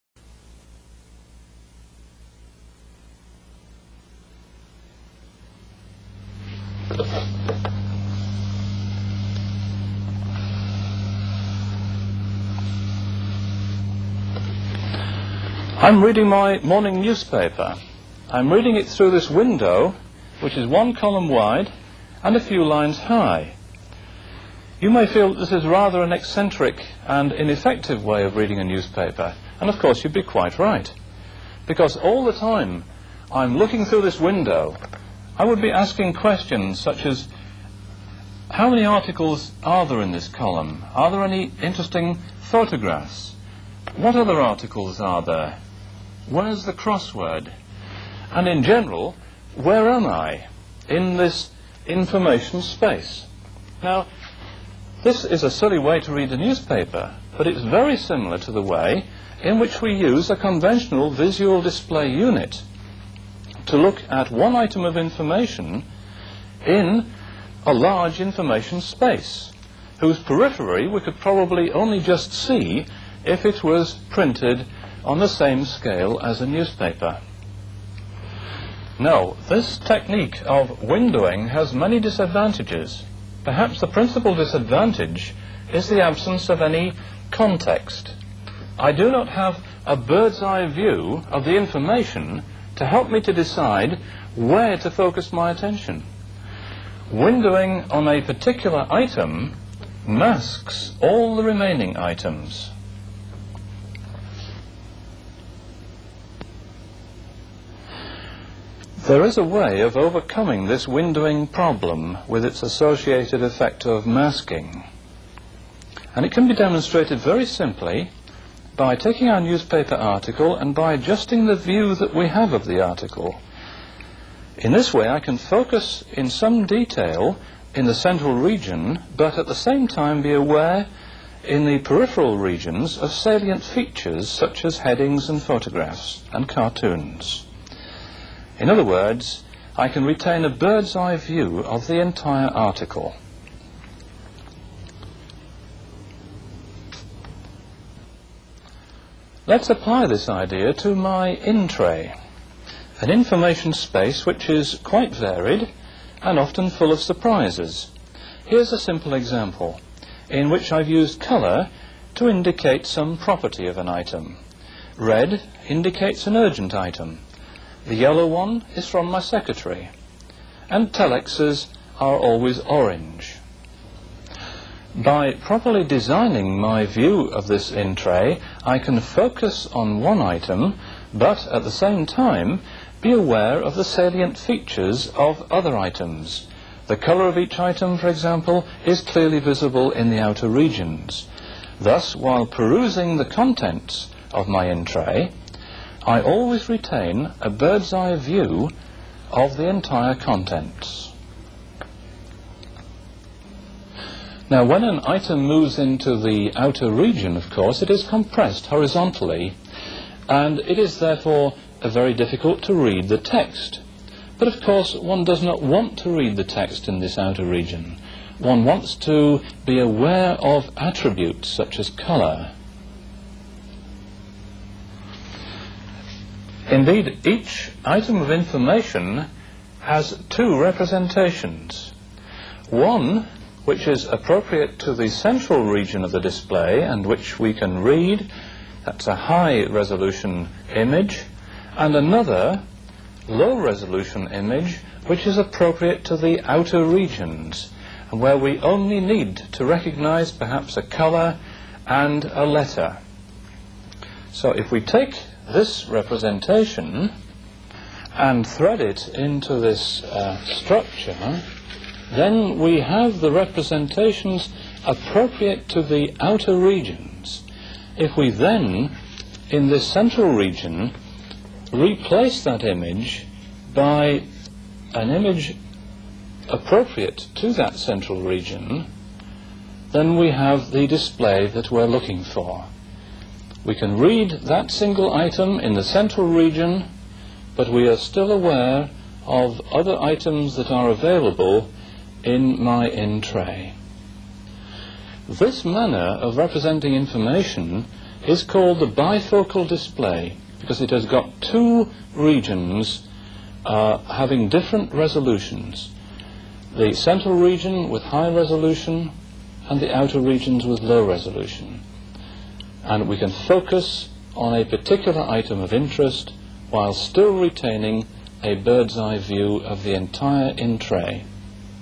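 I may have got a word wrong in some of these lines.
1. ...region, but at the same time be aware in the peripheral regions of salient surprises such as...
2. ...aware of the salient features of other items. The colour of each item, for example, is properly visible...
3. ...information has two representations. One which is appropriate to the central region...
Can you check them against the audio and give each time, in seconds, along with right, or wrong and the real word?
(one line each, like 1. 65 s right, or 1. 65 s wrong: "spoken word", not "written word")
1. 128 s wrong: "features", not "surprises"
2. 183 s wrong: "clearly", not "properly"
3. 228 s right.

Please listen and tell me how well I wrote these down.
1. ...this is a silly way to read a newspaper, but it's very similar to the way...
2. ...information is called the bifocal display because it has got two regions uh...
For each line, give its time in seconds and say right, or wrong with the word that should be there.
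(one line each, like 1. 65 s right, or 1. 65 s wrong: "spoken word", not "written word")
1. 55 s right
2. 296 s right.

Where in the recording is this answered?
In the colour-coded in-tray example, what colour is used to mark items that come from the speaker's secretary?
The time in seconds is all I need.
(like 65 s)
167 s.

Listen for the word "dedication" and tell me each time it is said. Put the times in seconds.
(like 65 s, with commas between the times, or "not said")
not said.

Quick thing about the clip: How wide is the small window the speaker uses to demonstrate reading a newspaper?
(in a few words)
one column wide.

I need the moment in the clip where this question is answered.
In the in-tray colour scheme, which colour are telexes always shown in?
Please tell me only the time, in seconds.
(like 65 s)
172 s.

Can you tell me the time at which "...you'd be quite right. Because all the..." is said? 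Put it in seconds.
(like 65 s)
30 s.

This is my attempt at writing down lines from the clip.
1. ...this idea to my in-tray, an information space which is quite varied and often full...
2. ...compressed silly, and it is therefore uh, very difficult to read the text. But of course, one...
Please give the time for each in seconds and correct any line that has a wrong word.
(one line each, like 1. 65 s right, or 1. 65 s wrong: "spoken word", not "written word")
1. 150 s right
2. 208 s wrong: "horizontally", not "silly".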